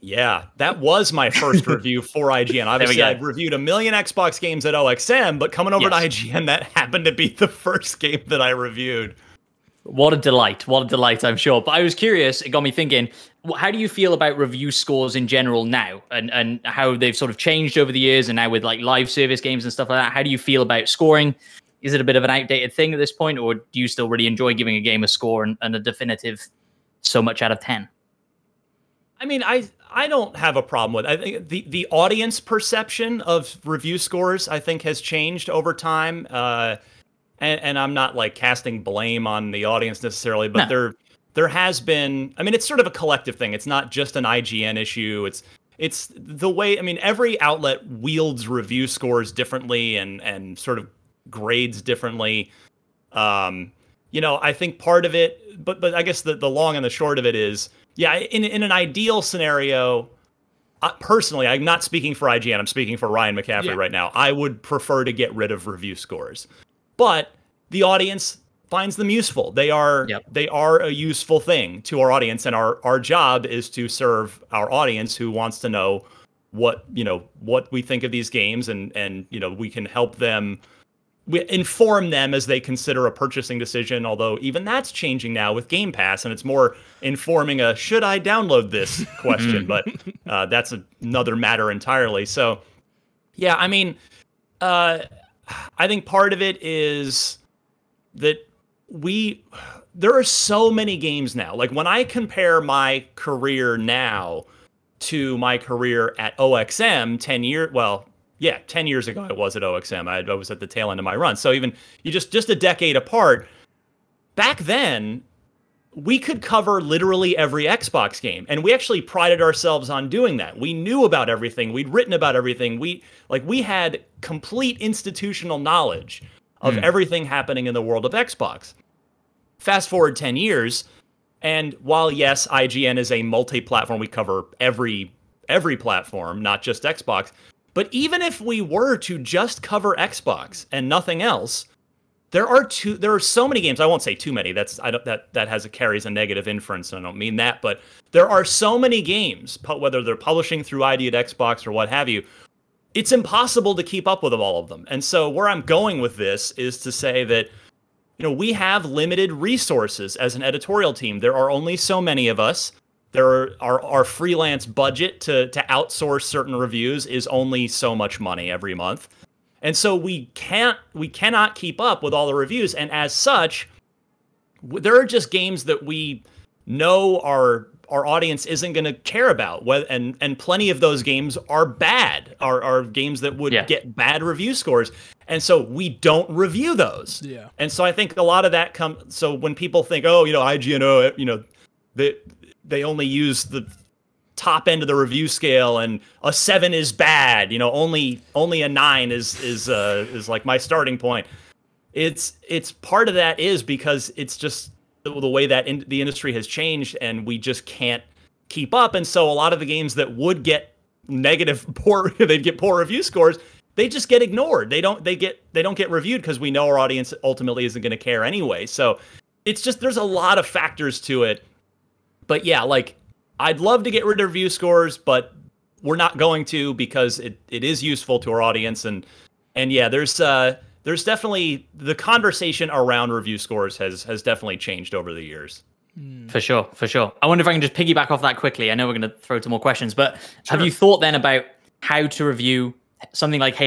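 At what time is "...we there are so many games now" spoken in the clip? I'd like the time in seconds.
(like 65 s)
98 s.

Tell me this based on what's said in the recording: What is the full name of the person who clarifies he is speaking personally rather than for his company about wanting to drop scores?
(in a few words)
Ryan McCaffrey.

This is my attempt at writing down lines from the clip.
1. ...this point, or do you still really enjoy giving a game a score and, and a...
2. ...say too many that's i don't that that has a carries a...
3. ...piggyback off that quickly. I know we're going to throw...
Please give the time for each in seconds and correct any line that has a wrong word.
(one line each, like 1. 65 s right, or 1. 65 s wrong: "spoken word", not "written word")
1. 22 s right
2. 144 s right
3. 237 s right.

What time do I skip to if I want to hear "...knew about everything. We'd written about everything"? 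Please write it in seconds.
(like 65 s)
120 s.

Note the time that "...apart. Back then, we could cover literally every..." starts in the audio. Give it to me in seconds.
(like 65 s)
112 s.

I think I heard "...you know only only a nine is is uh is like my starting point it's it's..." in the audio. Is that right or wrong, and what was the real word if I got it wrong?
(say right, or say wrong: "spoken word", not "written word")
right.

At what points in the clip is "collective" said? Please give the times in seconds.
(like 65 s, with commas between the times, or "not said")
42 s.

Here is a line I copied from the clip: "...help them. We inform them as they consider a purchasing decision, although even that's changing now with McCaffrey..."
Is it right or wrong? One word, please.
wrong.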